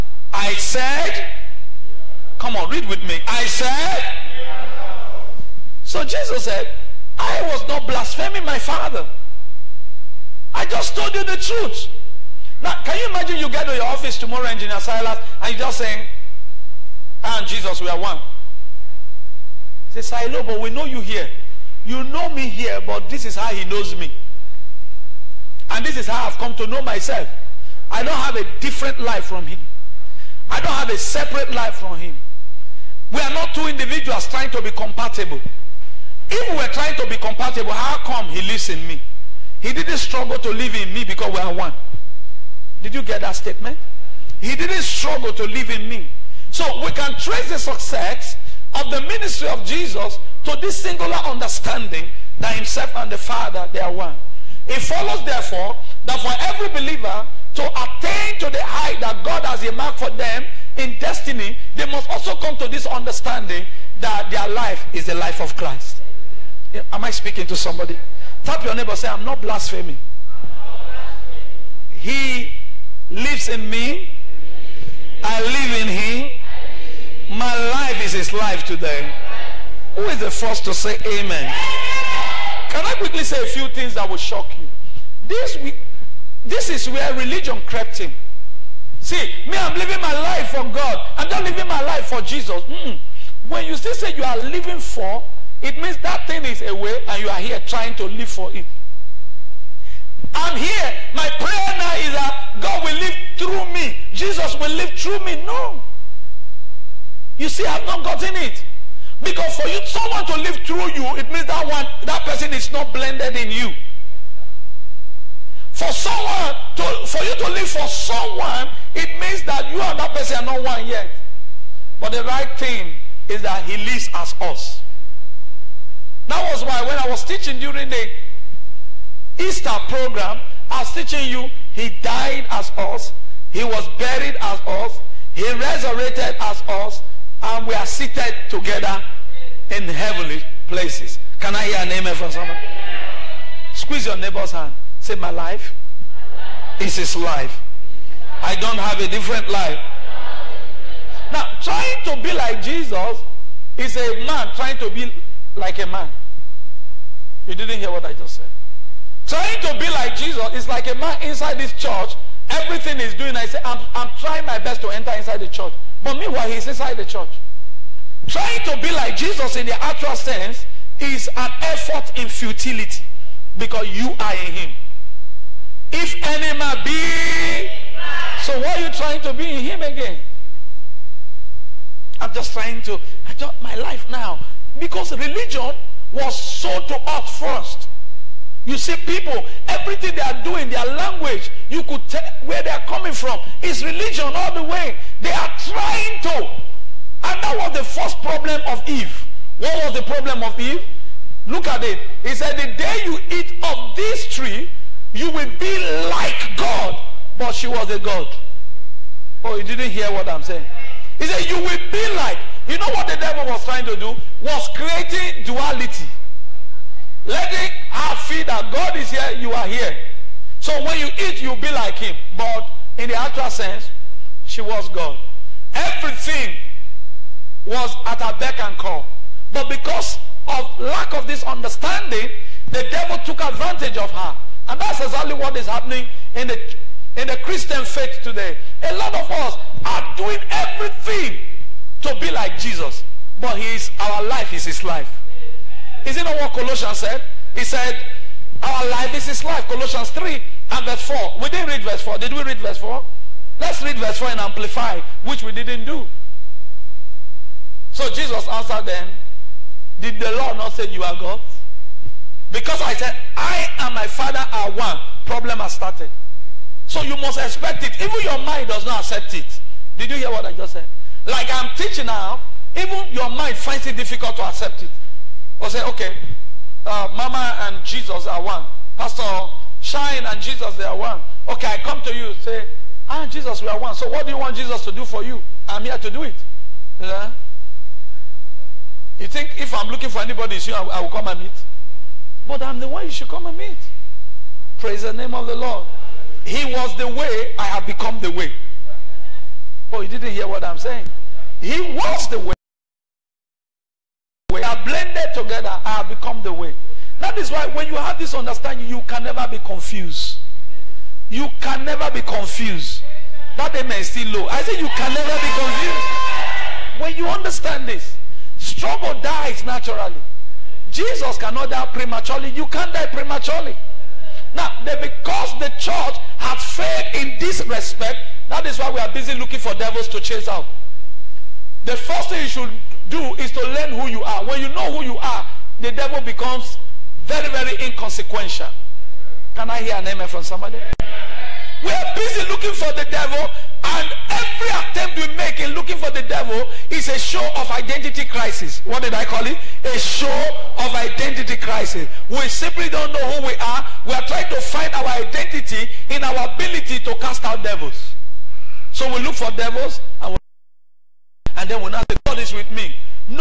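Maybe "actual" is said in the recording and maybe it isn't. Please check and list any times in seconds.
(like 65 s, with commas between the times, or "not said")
169 s, 223 s.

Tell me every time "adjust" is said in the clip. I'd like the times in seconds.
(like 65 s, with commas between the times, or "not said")
183 s.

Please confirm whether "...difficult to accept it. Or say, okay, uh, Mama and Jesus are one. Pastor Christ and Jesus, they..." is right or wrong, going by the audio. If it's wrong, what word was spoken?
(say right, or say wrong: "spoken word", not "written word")
wrong: "Shine", not "Christ".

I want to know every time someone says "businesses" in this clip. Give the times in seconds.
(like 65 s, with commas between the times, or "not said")
not said.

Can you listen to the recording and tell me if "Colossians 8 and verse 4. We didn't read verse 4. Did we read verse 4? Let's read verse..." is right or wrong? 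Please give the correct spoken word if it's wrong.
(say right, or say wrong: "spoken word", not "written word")
wrong: "3", not "8".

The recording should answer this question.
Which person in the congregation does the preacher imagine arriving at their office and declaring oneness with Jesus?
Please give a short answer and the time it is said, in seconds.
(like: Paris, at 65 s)
Engineer Silas, at 14 s.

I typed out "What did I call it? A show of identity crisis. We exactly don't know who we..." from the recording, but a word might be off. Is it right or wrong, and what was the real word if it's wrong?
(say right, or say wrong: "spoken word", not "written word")
wrong: "simply", not "exactly".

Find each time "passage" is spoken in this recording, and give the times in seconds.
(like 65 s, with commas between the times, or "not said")
not said.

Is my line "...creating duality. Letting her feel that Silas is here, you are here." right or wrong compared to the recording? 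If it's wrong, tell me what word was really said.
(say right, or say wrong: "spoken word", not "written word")
wrong: "God", not "Silas".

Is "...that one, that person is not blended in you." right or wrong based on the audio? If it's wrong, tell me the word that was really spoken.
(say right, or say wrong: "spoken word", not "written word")
right.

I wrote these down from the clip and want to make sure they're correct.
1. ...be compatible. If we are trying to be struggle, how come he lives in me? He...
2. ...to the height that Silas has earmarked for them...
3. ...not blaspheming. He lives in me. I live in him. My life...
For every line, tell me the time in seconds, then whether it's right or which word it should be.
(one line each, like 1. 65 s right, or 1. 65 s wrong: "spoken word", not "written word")
1. 34 s wrong: "compatible", not "struggle"
2. 58 s wrong: "God", not "Silas"
3. 69 s right.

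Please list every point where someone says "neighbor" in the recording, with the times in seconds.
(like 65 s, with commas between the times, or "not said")
68 s, 144 s.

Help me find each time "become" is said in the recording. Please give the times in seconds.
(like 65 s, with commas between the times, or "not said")
297 s, 306 s, 336 s.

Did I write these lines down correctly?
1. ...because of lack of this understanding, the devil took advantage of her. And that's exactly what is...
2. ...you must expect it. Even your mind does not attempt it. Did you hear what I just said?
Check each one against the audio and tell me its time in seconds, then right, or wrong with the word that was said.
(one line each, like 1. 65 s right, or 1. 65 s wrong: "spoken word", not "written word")
1. 229 s right
2. 267 s wrong: "accept", not "attempt".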